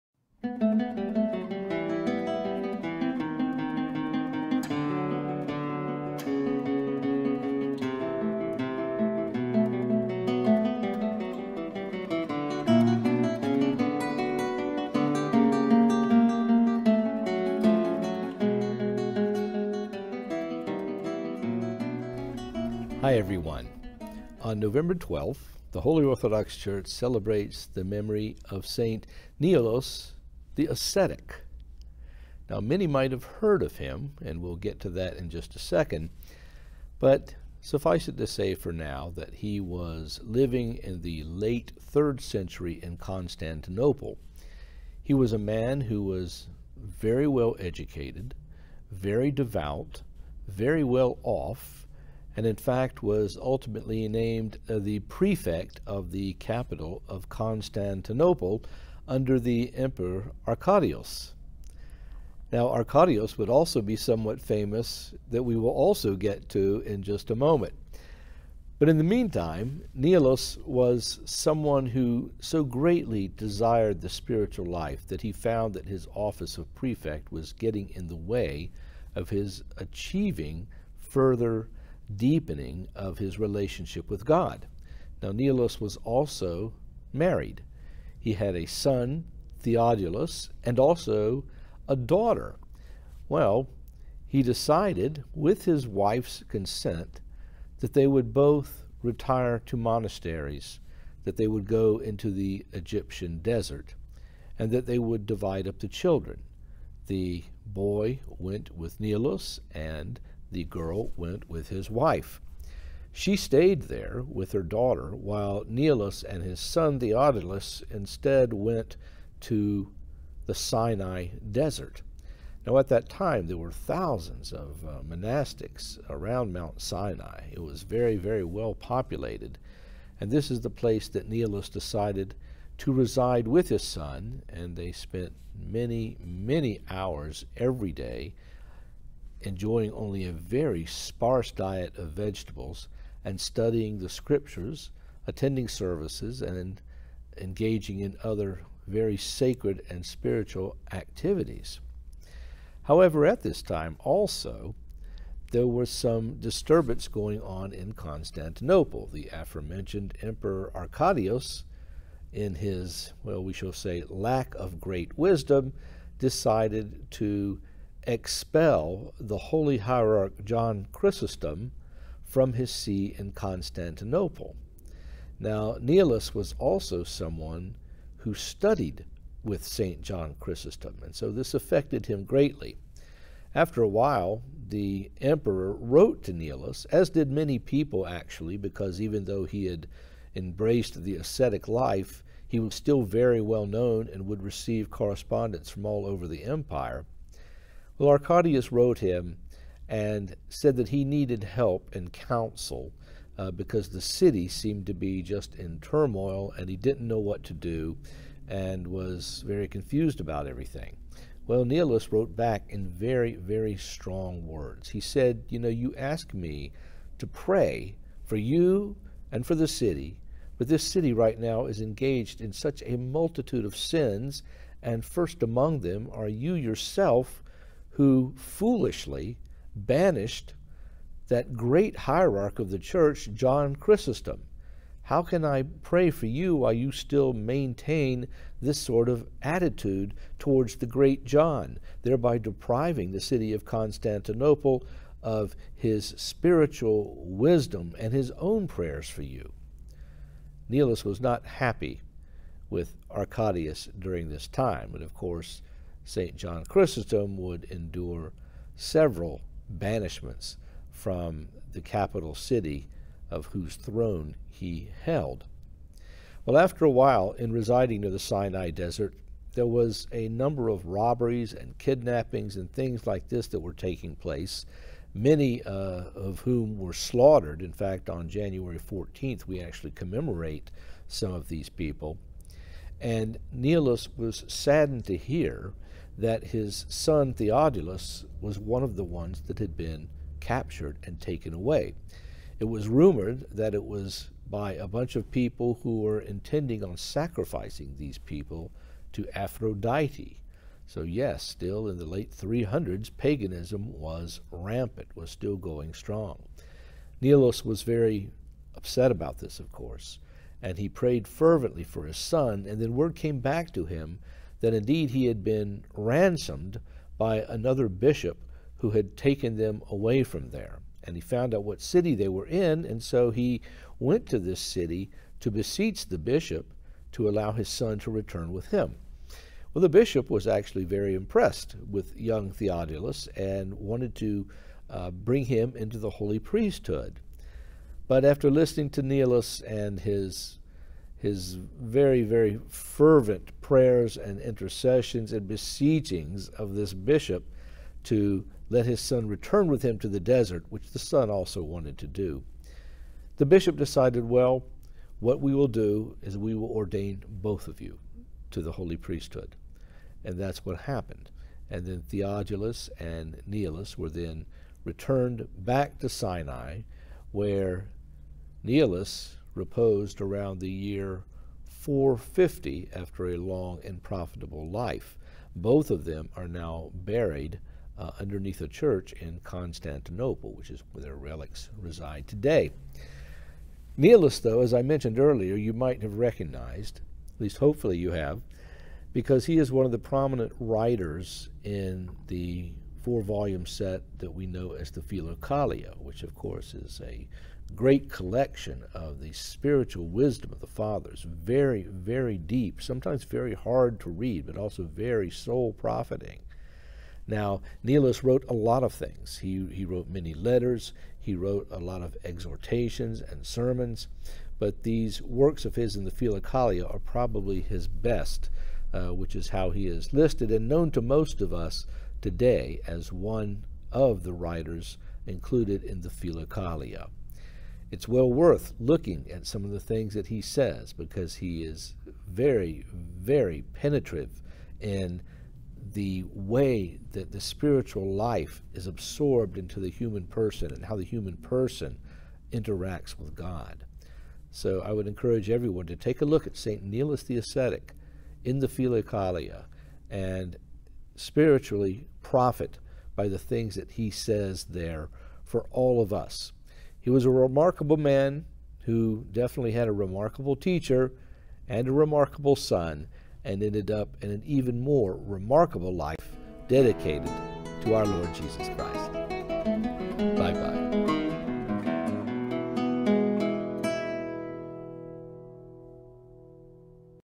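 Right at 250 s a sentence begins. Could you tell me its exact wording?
Nilus was not happy with Arcadius during this time, and of course, St.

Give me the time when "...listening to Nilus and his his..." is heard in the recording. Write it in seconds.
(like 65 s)
338 s.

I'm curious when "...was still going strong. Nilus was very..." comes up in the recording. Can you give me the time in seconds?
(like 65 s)
305 s.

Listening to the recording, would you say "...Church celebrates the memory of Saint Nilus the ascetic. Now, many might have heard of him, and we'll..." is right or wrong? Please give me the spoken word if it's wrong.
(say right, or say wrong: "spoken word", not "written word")
right.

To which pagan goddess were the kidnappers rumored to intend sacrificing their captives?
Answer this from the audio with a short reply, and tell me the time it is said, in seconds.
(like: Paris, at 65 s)
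Aphrodite, at 299 s.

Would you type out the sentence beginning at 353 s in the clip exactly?
The bishop decided, well, what we will do is we will ordain both of you to the holy priesthood.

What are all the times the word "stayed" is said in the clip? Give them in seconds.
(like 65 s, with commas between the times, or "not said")
113 s.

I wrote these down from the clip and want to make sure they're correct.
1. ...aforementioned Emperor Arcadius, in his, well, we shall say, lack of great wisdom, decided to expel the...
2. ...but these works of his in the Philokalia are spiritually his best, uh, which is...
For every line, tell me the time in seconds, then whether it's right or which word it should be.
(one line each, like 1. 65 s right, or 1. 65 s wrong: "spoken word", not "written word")
1. 159 s right
2. 414 s wrong: "probably", not "spiritually".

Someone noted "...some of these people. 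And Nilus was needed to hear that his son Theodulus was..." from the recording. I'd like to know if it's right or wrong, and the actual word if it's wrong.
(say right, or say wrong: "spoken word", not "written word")
wrong: "saddened", not "needed".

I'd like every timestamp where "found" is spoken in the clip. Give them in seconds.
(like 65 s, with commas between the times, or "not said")
75 s, 321 s.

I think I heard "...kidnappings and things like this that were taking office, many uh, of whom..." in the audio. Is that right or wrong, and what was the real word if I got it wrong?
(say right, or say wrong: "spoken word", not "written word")
wrong: "place", not "office".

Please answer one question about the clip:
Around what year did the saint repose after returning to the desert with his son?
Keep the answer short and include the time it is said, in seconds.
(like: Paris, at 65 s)
450, at 371 s.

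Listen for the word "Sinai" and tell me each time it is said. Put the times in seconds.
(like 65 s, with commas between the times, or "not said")
120 s, 126 s, 268 s, 366 s.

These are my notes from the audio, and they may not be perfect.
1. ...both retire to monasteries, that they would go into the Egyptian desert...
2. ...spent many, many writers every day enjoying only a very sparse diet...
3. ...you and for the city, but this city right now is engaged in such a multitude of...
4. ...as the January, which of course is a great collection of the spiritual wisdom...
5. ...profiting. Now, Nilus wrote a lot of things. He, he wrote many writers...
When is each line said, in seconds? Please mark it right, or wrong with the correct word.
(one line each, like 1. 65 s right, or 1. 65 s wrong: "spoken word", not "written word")
1. 98 s right
2. 134 s wrong: "hours", not "writers"
3. 218 s right
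4. 394 s wrong: "Philokalia", not "January"
5. 405 s wrong: "letters", not "writers".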